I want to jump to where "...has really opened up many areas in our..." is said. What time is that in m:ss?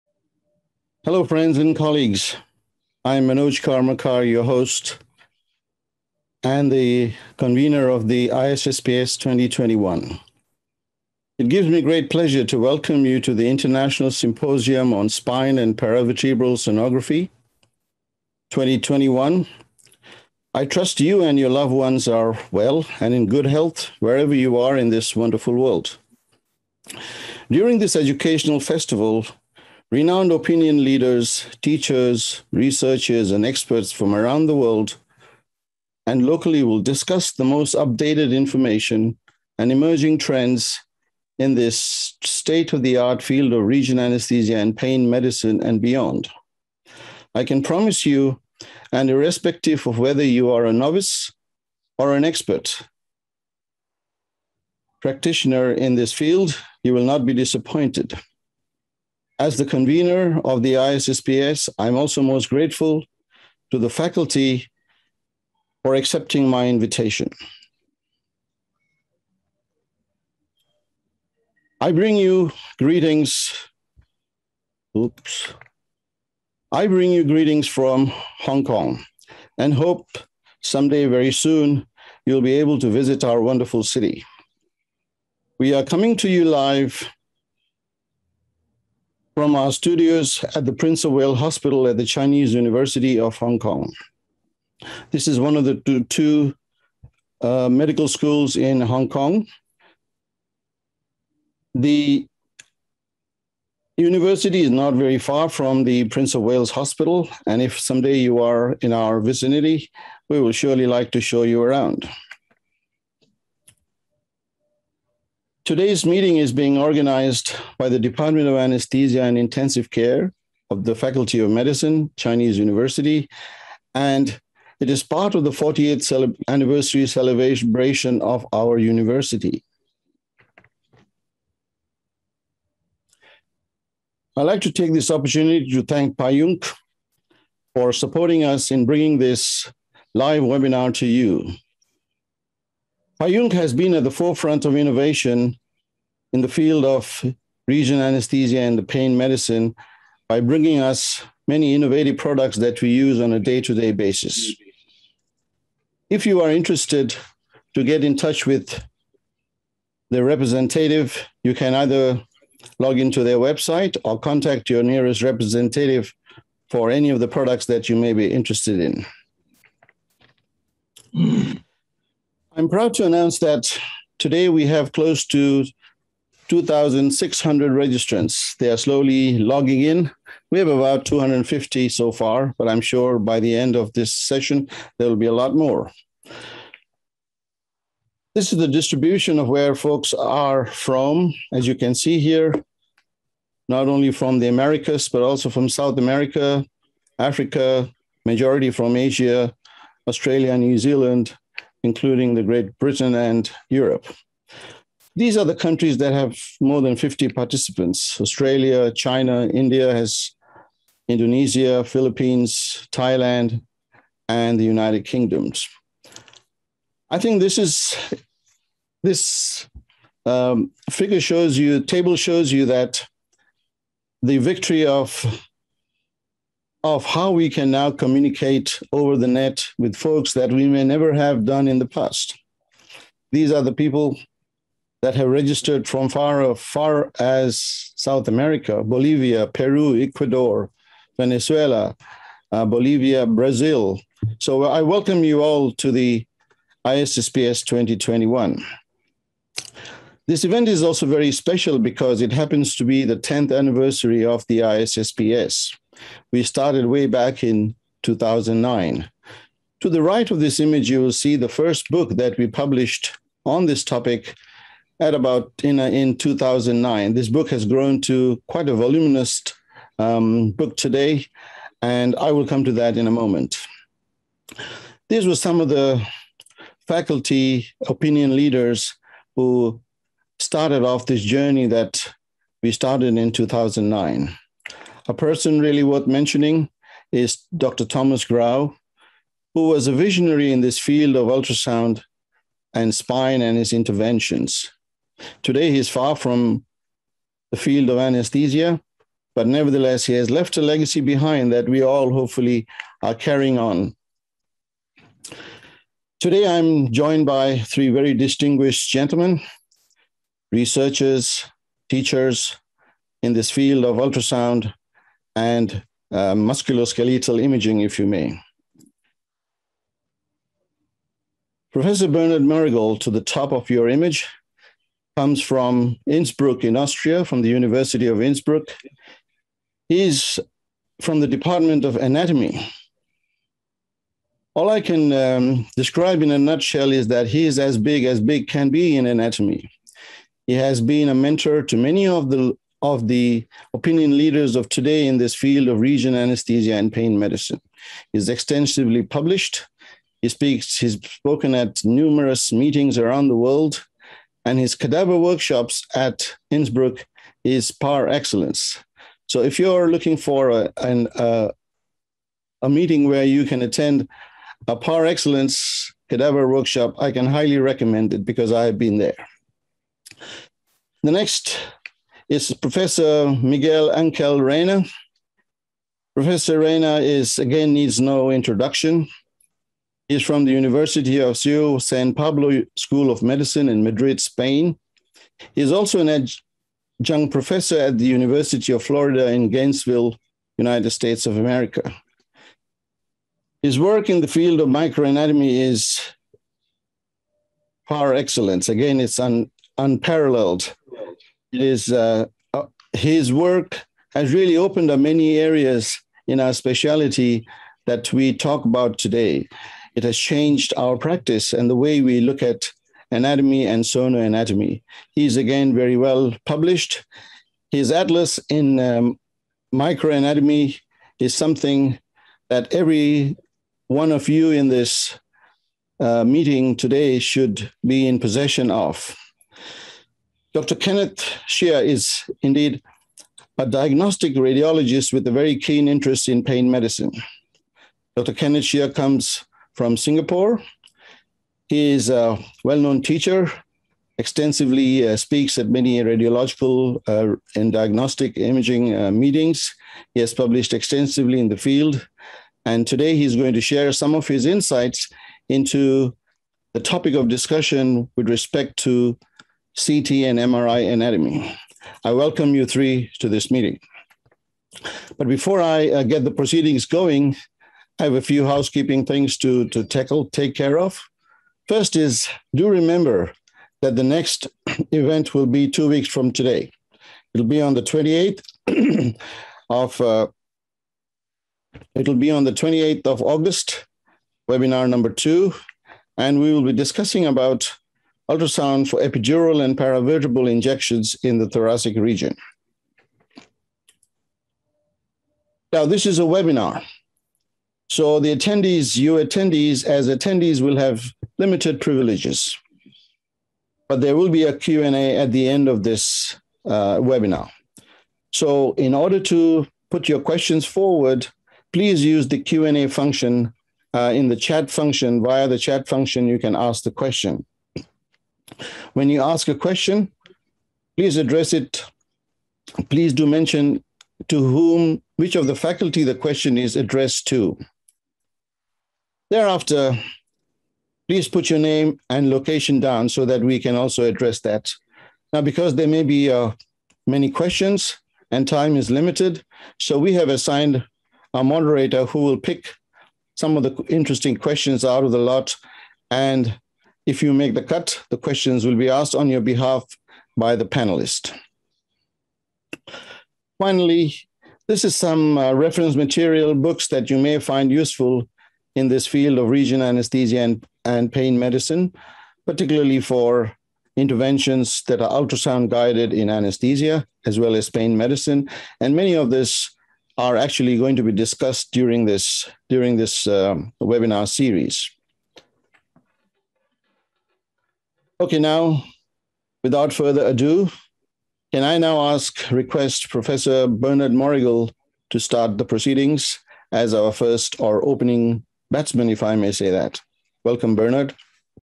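6:44.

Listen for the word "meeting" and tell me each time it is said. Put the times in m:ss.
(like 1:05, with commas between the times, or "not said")
1:56, 5:52, 6:02, 7:06, 7:29, 7:43.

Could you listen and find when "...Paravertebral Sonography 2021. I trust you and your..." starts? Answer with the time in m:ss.
0:15.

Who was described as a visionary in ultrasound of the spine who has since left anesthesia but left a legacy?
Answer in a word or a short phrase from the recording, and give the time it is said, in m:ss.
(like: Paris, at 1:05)
Thomas Grau, at 4:47.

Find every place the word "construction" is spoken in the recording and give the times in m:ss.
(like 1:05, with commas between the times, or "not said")
not said.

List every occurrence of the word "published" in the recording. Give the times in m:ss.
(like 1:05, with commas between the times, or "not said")
4:22, 5:49, 6:56, 7:30.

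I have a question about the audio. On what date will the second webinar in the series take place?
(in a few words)
28th of August.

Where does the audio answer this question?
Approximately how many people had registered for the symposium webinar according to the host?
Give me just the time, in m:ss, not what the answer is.
2:56.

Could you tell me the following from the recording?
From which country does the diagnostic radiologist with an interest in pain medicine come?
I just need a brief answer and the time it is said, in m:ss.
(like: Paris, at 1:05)
Singapore, at 7:19.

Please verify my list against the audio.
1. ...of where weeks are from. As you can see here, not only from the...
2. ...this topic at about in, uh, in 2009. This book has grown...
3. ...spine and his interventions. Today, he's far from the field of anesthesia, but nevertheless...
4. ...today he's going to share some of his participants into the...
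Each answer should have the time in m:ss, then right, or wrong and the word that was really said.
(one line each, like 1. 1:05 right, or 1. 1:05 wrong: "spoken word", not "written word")
1. 3:09 wrong: "folks", not "weeks"
2. 4:23 right
3. 4:52 right
4. 7:32 wrong: "insights", not "participants".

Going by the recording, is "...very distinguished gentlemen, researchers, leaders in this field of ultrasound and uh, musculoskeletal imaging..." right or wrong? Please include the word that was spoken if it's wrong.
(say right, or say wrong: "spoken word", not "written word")
wrong: "teachers", not "leaders".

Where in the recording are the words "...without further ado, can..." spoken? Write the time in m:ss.
9:39.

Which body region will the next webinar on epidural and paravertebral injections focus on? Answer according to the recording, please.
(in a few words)
thoracic region.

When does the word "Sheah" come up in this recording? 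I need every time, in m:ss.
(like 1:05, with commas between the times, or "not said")
7:11, 7:18.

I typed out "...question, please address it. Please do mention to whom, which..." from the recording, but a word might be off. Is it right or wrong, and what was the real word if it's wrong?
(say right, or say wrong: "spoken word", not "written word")
right.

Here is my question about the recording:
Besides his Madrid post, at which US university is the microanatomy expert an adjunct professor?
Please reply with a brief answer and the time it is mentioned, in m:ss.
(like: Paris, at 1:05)
University of Florida, at 6:28.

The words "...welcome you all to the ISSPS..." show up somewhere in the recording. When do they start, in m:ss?
4:04.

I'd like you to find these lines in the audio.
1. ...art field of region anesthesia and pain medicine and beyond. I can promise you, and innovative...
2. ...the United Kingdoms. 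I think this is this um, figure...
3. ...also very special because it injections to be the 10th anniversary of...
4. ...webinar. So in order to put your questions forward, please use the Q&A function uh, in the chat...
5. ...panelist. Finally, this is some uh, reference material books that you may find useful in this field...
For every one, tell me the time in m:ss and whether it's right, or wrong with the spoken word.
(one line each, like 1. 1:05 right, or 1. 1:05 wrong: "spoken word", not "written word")
1. 0:42 wrong: "irrespective", not "innovative"
2. 3:34 right
3. 4:10 wrong: "happens", not "injections"
4. 8:26 right
5. 9:10 right.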